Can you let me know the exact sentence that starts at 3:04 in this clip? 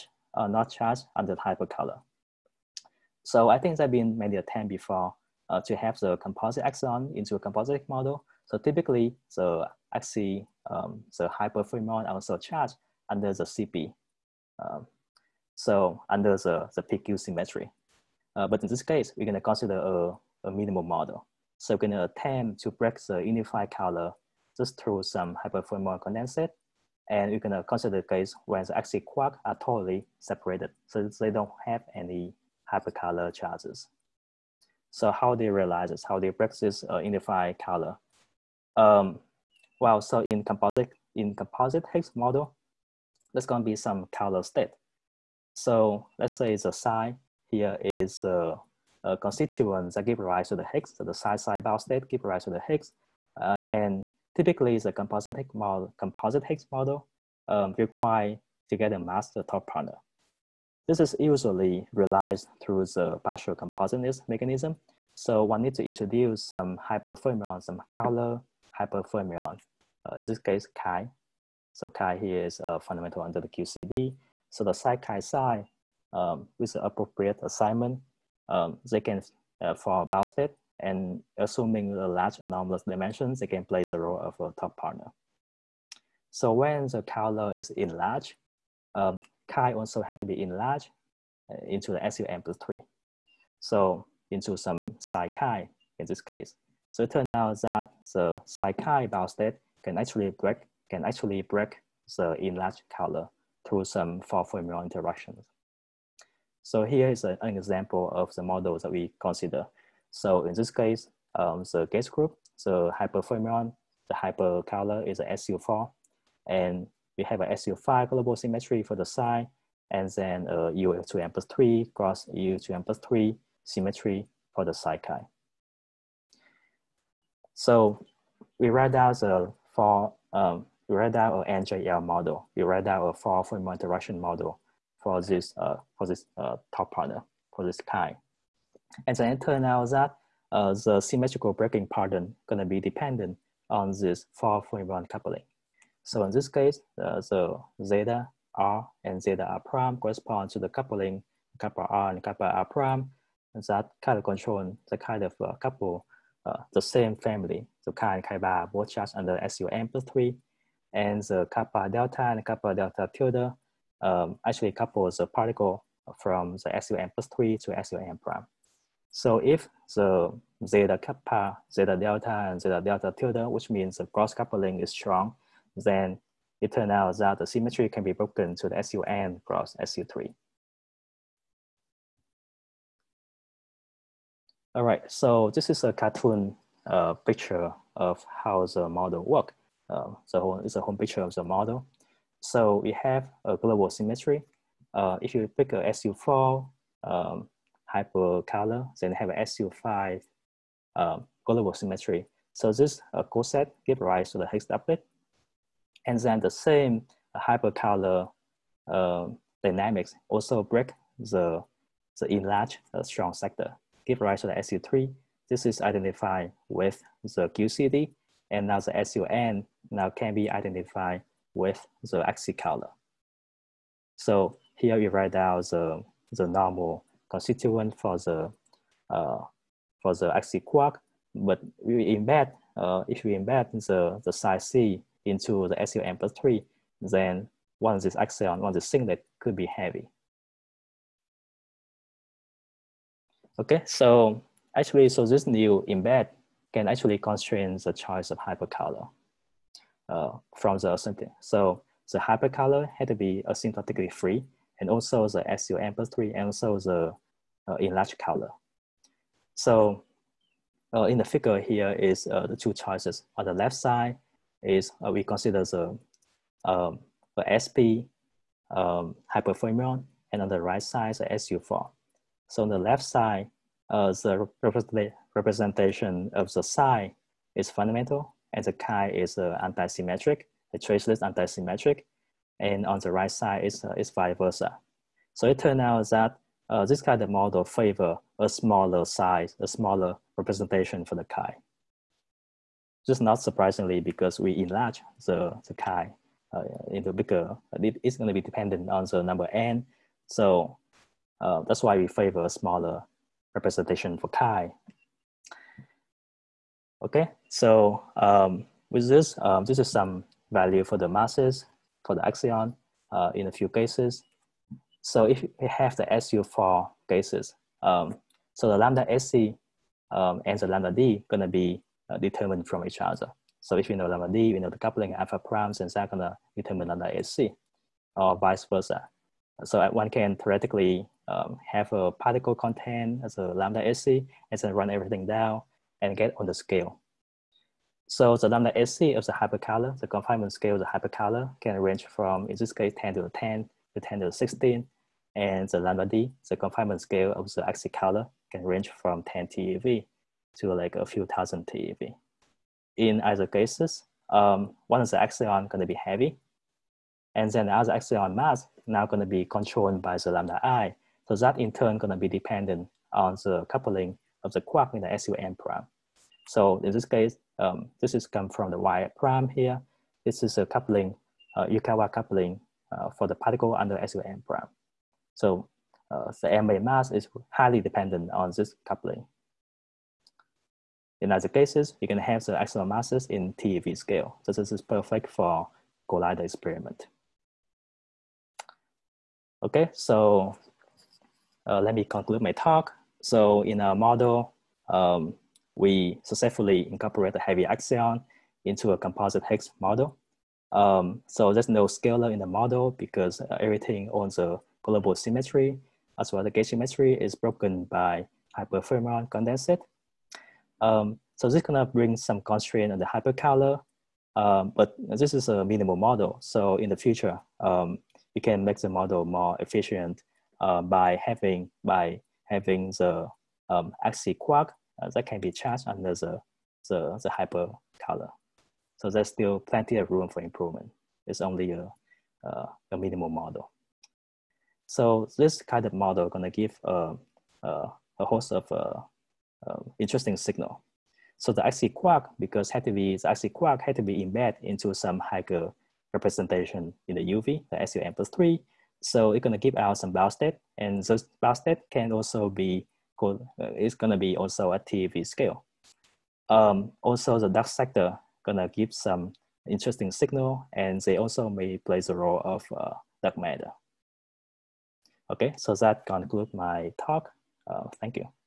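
All right, so this is a cartoon uh, picture of how the model works.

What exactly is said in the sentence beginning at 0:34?
So how they realize this, how they practice uh, unify color.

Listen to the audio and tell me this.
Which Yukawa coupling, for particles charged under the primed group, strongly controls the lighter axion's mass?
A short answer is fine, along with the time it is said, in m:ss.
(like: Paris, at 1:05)
y prime, at 6:08.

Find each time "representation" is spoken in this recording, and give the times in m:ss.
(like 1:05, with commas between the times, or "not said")
4:35, 4:50, 5:03, 7:26.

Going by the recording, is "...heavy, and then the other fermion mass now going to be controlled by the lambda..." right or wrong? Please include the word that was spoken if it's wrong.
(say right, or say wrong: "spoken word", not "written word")
wrong: "axion", not "fermion".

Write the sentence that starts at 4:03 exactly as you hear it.
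Okay, so actually, so this new embed can actually constrain the choice of hypercolor uh, from the asymptotic.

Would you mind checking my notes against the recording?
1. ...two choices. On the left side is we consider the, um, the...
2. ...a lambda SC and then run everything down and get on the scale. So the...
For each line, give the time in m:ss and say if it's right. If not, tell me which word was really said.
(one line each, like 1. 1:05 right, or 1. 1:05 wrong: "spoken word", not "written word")
1. 4:22 right
2. 5:33 right.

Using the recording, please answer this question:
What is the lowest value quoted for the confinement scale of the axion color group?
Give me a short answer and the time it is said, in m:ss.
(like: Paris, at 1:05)
10 TeV, at 5:49.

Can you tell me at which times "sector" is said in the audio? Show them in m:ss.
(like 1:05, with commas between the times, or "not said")
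3:33, 7:37.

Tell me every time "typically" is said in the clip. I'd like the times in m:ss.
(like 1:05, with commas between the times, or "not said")
0:08, 0:54.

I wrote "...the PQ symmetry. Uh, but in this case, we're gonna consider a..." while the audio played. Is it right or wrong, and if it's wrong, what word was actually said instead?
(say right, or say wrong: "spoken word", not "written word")
right.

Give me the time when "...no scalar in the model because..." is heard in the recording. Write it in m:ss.
6:41.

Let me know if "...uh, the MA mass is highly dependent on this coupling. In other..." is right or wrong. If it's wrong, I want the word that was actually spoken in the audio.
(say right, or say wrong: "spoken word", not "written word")
right.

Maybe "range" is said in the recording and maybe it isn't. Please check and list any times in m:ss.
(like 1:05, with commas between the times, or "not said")
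5:41, 5:48.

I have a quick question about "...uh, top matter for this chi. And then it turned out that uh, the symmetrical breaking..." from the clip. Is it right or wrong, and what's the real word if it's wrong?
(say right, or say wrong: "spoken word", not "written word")
wrong: "partner", not "matter".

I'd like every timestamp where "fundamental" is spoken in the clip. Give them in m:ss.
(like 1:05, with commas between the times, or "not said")
1:12, 4:37.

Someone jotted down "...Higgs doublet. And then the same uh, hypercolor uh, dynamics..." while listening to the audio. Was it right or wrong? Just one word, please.
right.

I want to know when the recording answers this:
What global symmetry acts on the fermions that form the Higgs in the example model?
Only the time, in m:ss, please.
1:57.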